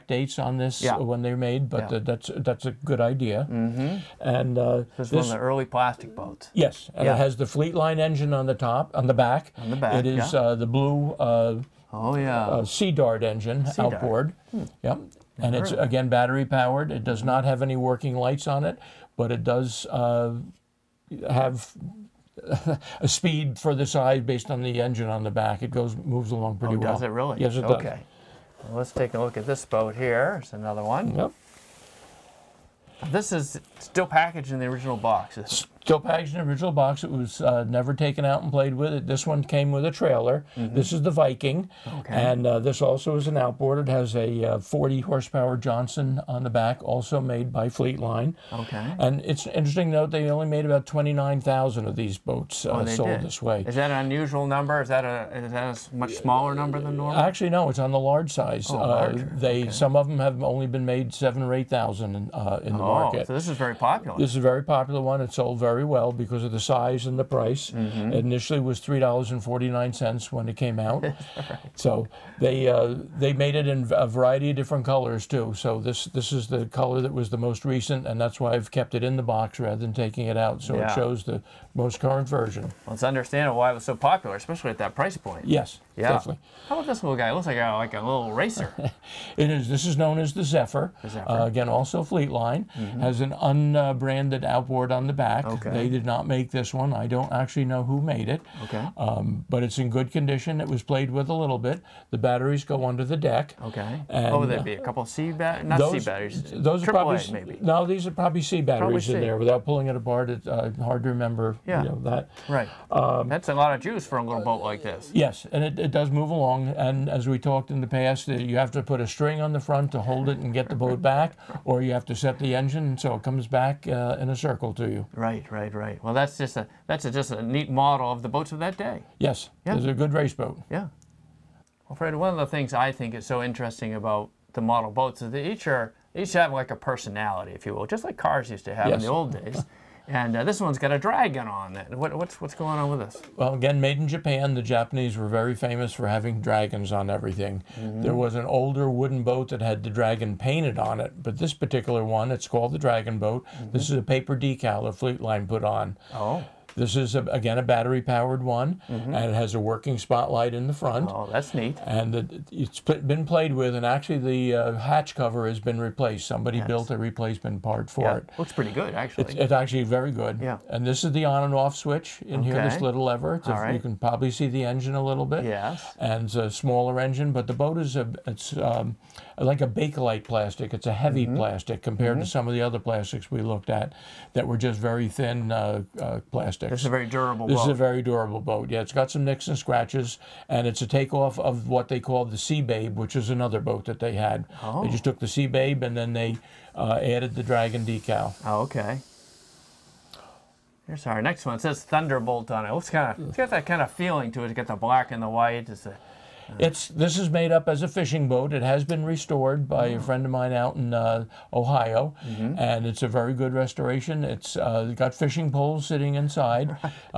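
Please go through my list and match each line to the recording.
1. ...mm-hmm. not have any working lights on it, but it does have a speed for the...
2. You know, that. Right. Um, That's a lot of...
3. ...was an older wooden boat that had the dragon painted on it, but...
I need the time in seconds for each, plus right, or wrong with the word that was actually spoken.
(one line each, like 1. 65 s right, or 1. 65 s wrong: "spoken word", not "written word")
1. 17 s right
2. 111 s right
3. 148 s right.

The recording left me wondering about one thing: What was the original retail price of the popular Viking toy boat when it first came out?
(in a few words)
$3.49.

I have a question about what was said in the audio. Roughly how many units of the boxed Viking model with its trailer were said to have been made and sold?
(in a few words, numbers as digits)
29,000.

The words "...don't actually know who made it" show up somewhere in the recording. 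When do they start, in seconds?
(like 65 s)
97 s.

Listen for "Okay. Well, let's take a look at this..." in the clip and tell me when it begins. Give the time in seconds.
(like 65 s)
27 s.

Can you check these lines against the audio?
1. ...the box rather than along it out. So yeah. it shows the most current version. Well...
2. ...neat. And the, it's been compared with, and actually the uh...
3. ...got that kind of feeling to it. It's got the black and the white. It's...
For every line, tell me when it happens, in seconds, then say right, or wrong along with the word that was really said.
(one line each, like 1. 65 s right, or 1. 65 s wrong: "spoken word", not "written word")
1. 79 s wrong: "taking", not "along"
2. 161 s wrong: "played", not "compared"
3. 203 s right.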